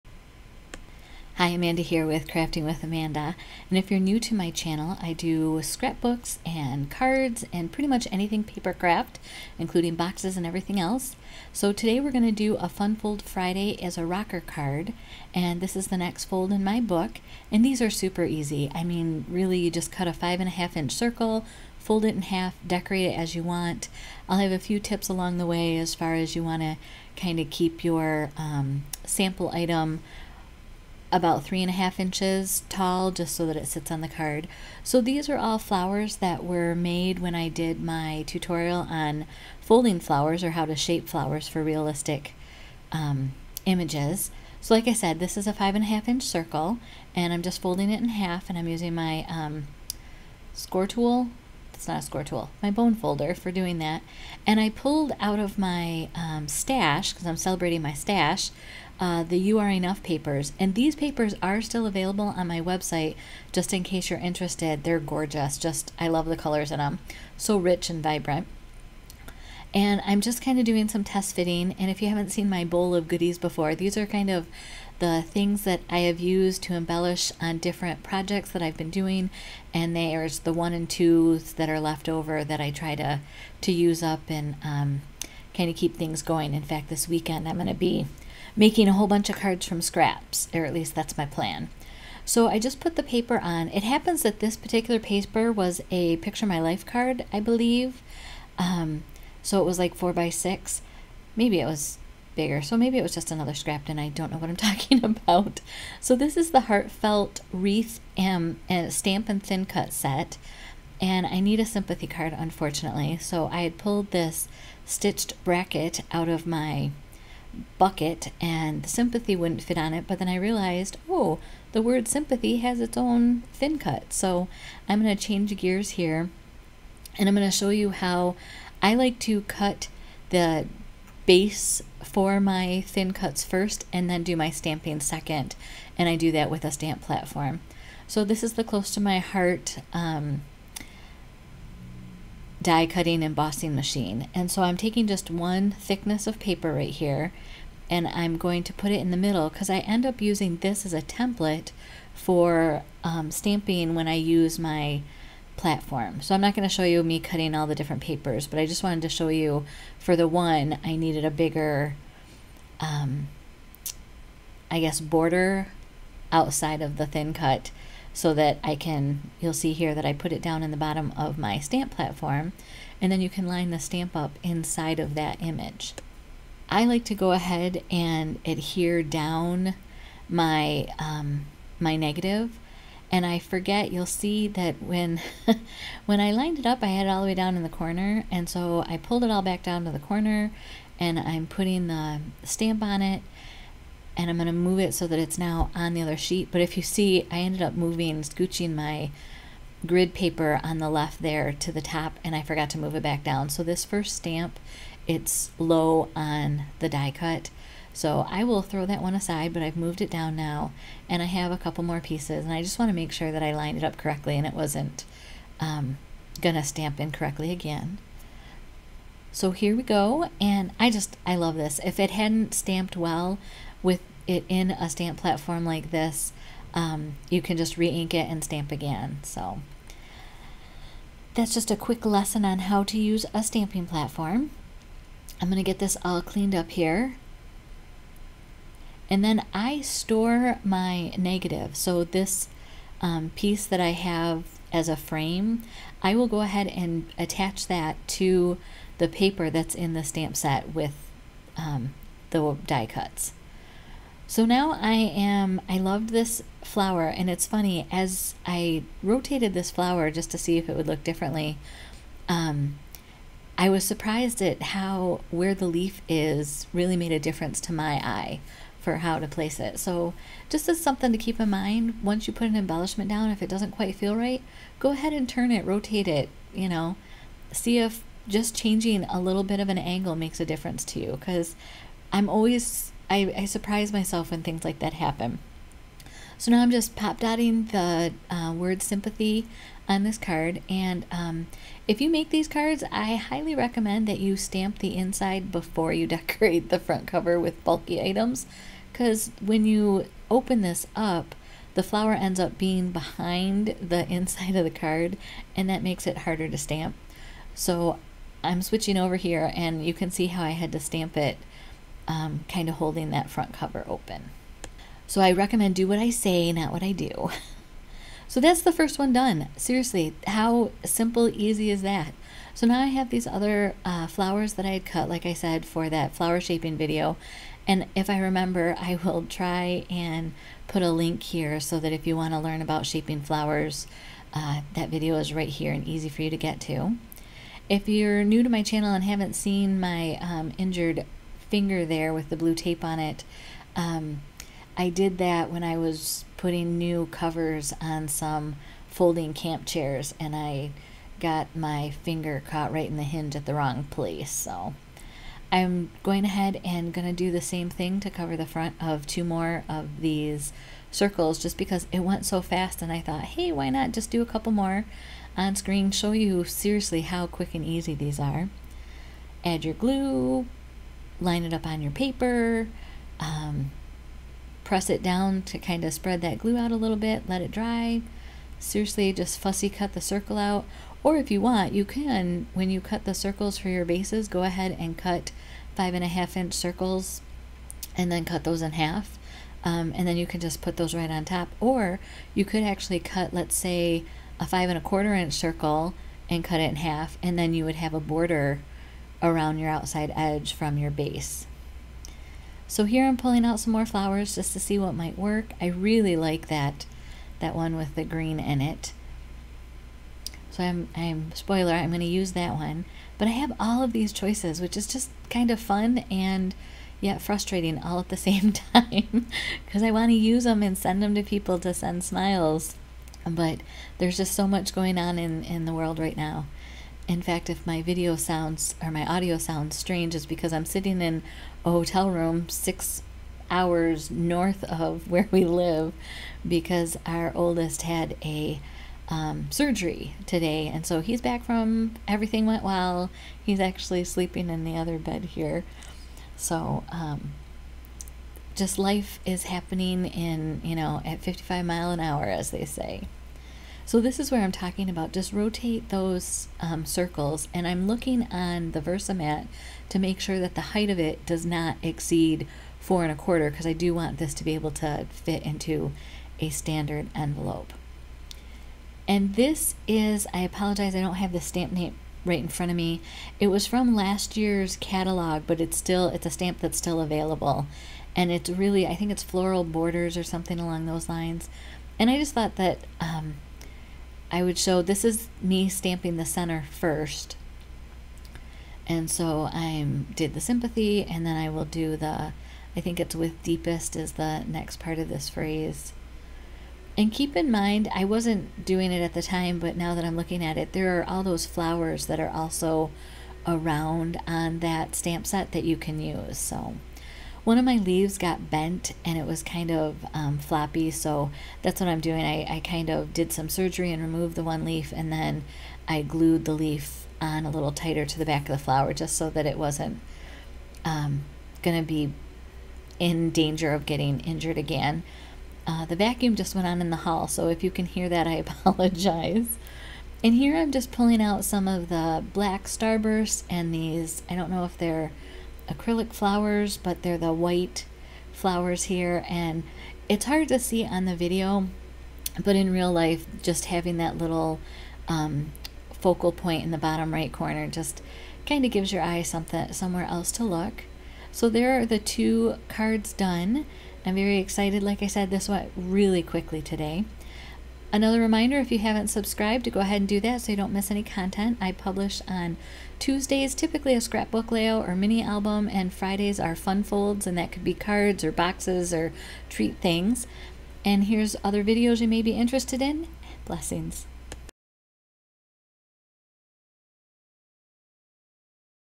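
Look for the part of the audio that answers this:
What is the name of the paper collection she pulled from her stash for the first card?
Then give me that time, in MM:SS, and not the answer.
00:59.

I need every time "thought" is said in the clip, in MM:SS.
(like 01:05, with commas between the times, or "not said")
06:03, 08:02.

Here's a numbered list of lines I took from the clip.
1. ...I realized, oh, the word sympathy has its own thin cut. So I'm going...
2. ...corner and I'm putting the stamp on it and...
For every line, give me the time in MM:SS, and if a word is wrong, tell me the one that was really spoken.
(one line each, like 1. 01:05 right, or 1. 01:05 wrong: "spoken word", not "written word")
1. 02:00 right
2. 03:09 right.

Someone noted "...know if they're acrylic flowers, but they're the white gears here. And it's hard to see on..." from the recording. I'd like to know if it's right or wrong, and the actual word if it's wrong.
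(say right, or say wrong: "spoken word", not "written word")
wrong: "flowers", not "gears".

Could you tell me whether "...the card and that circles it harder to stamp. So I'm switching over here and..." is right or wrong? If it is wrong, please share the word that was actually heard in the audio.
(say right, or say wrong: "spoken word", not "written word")
wrong: "makes", not "circles".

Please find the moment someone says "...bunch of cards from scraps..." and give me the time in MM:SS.
01:29.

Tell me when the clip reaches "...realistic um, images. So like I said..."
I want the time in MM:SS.
00:41.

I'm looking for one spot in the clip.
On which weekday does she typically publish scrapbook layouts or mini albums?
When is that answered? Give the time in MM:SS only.
09:22.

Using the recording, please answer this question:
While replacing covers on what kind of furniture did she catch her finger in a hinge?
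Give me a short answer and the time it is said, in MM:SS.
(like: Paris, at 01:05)
Folding camp chairs, at 05:48.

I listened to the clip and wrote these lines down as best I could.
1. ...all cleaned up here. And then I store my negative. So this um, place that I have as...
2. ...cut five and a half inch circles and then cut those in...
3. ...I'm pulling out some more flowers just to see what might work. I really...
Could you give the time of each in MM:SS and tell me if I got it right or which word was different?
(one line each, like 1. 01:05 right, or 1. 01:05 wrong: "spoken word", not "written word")
1. 03:56 wrong: "piece", not "place"
2. 06:24 right
3. 06:43 right.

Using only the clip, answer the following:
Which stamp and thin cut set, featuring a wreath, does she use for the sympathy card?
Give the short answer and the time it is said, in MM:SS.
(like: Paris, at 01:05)
Heartfelt wreath, at 01:46.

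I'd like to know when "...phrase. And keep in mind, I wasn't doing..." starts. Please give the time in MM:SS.
08:15.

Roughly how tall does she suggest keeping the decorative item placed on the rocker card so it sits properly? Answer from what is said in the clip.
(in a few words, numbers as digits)
3.5 inches.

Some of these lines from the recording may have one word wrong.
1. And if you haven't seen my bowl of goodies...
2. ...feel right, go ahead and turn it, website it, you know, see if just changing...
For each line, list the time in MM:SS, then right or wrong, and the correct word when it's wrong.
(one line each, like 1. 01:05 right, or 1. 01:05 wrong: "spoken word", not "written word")
1. 01:11 right
2. 04:33 wrong: "rotate", not "website".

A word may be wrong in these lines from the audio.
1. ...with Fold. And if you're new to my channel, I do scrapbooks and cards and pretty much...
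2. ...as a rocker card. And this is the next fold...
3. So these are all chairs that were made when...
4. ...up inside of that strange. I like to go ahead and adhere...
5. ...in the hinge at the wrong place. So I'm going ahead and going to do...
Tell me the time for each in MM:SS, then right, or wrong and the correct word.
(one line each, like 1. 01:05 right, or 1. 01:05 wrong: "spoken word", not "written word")
1. 00:02 wrong: "Amanda", not "Fold"
2. 00:13 right
3. 00:34 wrong: "flowers", not "chairs"
4. 02:54 wrong: "image", not "strange"
5. 05:52 right.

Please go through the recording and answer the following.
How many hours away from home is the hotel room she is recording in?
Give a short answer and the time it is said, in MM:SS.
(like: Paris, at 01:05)
6, at 07:12.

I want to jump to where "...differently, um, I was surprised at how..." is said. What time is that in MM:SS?
04:21.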